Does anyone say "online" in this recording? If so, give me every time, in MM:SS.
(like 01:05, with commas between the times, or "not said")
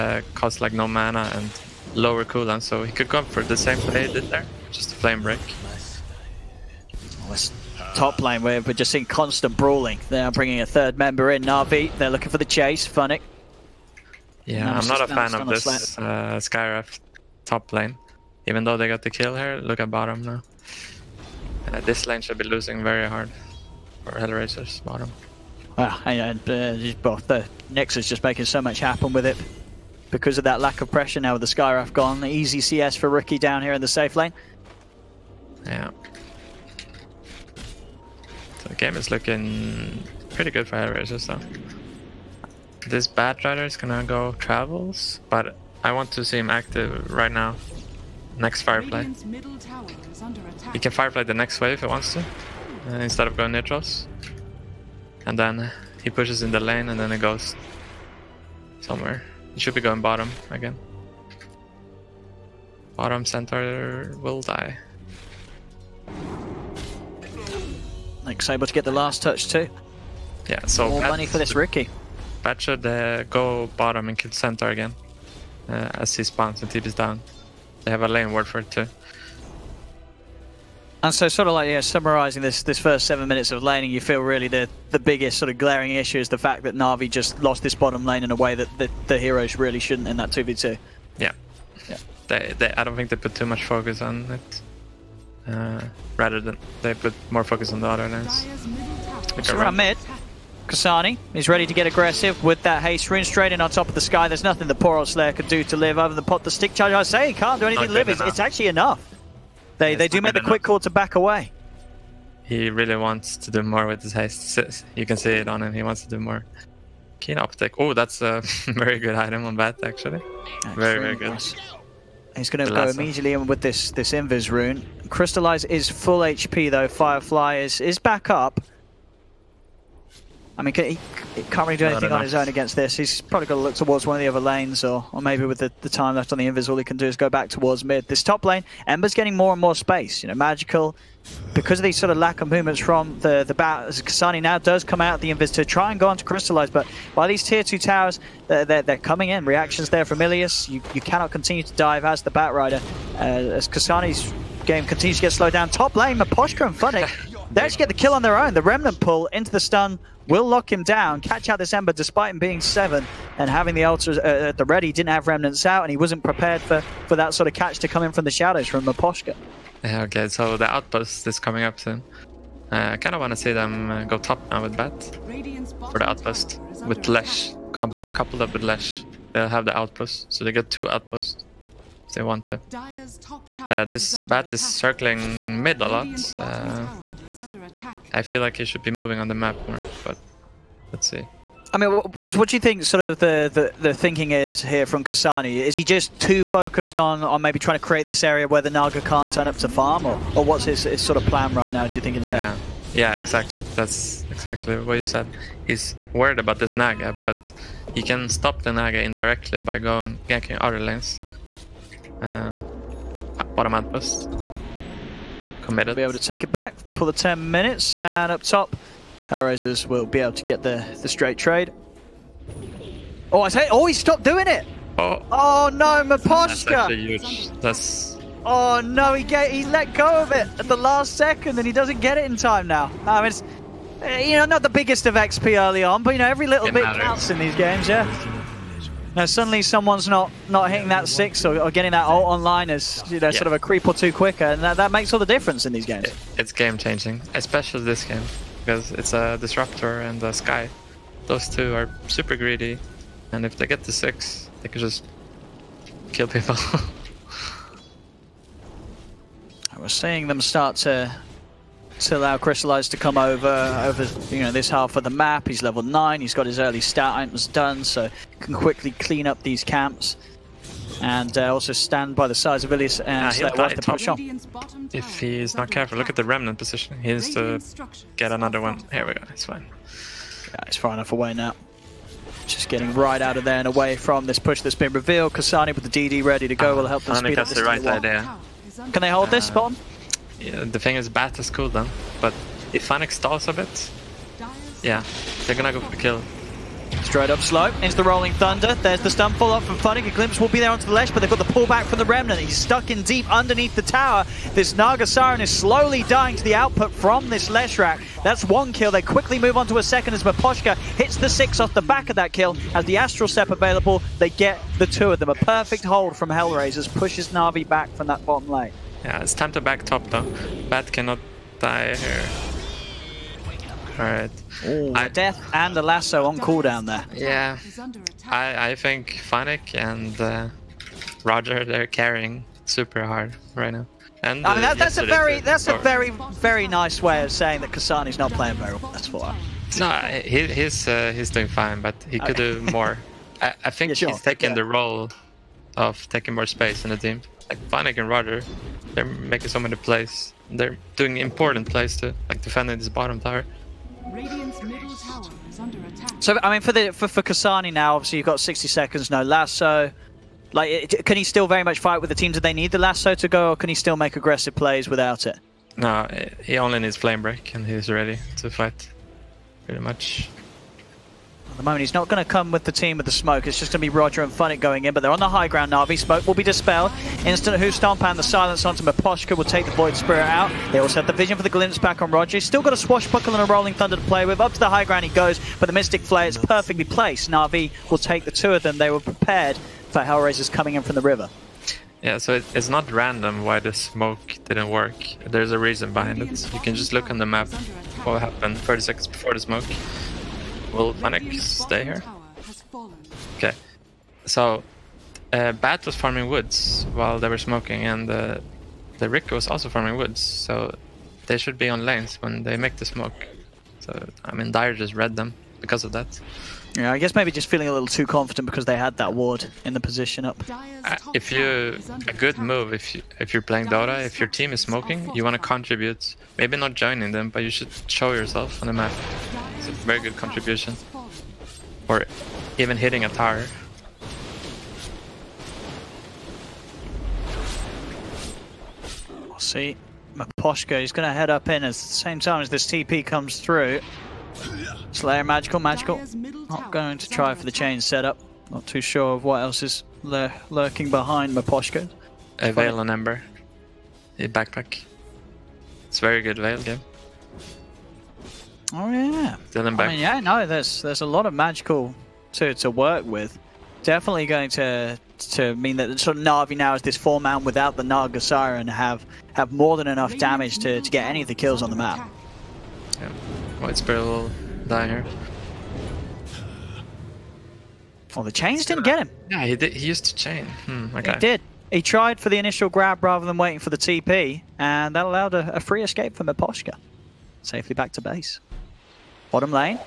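04:02.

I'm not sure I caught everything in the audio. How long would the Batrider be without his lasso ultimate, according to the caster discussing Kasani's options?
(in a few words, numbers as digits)
60 seconds.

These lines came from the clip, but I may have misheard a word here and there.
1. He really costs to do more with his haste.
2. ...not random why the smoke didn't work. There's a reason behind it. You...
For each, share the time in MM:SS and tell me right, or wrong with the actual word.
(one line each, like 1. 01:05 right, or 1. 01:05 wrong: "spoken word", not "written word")
1. 01:52 wrong: "wants", not "costs"
2. 06:32 right.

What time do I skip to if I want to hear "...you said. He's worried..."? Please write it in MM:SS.
03:24.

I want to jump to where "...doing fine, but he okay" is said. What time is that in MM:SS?
05:41.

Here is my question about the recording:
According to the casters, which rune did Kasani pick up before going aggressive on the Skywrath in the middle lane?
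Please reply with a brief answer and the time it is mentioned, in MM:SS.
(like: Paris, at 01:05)
Haste rune, at 01:42.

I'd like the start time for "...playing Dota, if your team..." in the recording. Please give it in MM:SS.
07:03.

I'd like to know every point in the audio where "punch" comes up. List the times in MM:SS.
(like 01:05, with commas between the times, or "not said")
not said.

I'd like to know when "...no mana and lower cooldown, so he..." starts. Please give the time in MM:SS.
00:00.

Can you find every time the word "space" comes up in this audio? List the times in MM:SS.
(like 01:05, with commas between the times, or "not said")
02:19, 05:46.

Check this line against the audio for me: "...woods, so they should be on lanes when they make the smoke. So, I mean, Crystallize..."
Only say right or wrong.
wrong.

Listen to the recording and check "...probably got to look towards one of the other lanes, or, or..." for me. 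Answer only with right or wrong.
right.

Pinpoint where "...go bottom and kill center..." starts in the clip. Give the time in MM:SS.
01:13.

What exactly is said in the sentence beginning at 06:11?
At the moment, he's not going to come with the team with the smoke.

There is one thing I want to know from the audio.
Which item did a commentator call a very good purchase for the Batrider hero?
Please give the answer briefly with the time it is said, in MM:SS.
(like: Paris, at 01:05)
Keen optic, at 01:57.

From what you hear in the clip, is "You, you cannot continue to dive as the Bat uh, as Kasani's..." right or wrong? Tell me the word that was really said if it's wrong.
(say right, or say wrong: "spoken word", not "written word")
right.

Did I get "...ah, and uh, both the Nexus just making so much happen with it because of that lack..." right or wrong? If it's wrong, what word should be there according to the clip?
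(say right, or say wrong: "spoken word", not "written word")
right.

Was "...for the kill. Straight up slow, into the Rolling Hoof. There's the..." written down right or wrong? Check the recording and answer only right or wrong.
wrong.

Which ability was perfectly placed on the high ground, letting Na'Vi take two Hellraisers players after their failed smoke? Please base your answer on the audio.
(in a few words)
Mystic Flare.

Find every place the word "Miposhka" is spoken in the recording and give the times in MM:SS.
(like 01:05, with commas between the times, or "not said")
02:36, 02:48, 03:46, 05:10, 06:18, 07:20, 08:06.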